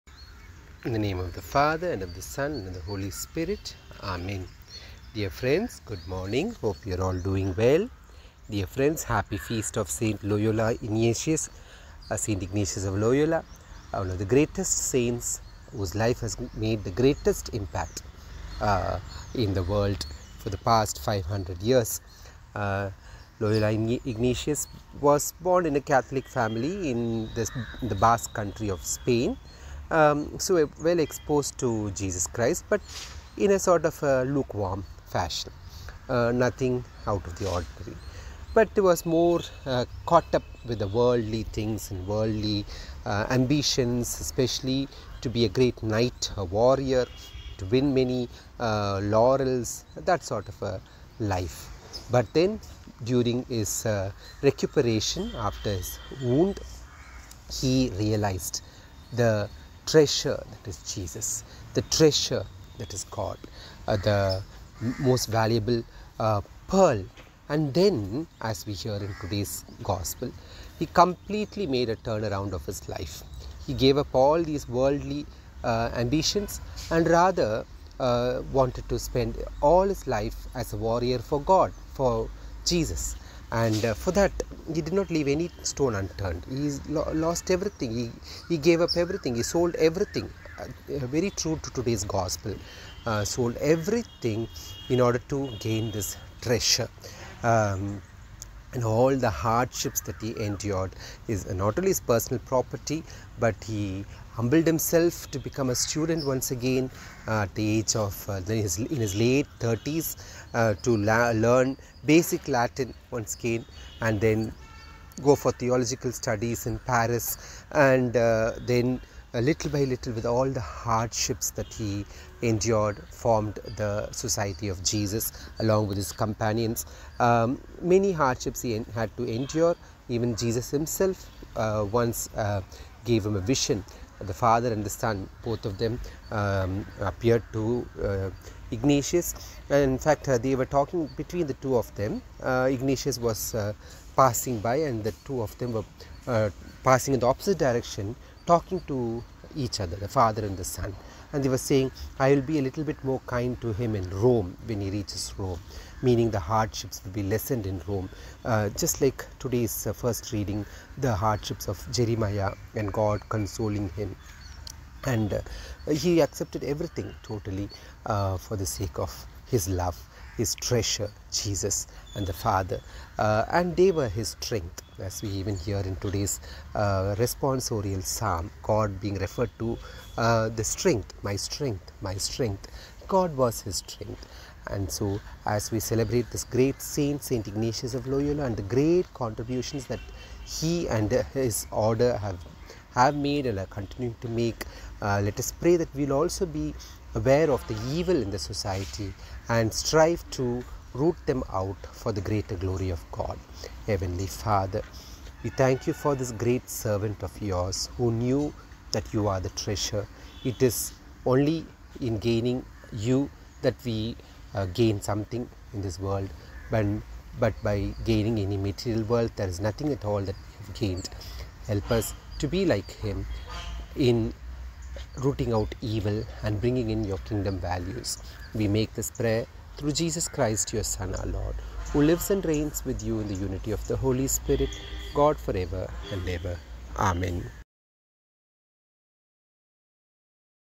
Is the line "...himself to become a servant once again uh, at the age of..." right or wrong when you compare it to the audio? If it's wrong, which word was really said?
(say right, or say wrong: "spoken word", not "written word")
wrong: "student", not "servant".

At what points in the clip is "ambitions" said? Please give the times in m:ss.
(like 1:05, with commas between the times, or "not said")
0:43, 1:15.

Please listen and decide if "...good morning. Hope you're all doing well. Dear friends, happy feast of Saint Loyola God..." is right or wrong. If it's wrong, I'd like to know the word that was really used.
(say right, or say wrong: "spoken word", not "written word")
wrong: "Ignatius", not "God".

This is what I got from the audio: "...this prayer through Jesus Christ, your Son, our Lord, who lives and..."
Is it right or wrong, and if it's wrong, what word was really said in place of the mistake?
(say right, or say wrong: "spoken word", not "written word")
right.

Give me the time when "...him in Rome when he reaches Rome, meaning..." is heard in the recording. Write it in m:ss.
2:33.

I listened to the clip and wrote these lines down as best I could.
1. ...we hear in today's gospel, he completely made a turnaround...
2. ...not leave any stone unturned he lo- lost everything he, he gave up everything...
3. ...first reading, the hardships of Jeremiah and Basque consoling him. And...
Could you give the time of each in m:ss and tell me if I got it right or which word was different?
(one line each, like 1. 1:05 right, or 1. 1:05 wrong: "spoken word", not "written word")
1. 1:08 right
2. 1:24 right
3. 2:39 wrong: "God", not "Basque".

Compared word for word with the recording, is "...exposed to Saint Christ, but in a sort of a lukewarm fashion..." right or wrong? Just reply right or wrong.
wrong.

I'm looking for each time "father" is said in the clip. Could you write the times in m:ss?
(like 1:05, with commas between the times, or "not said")
0:01, 2:14, 2:30, 2:52, 3:24.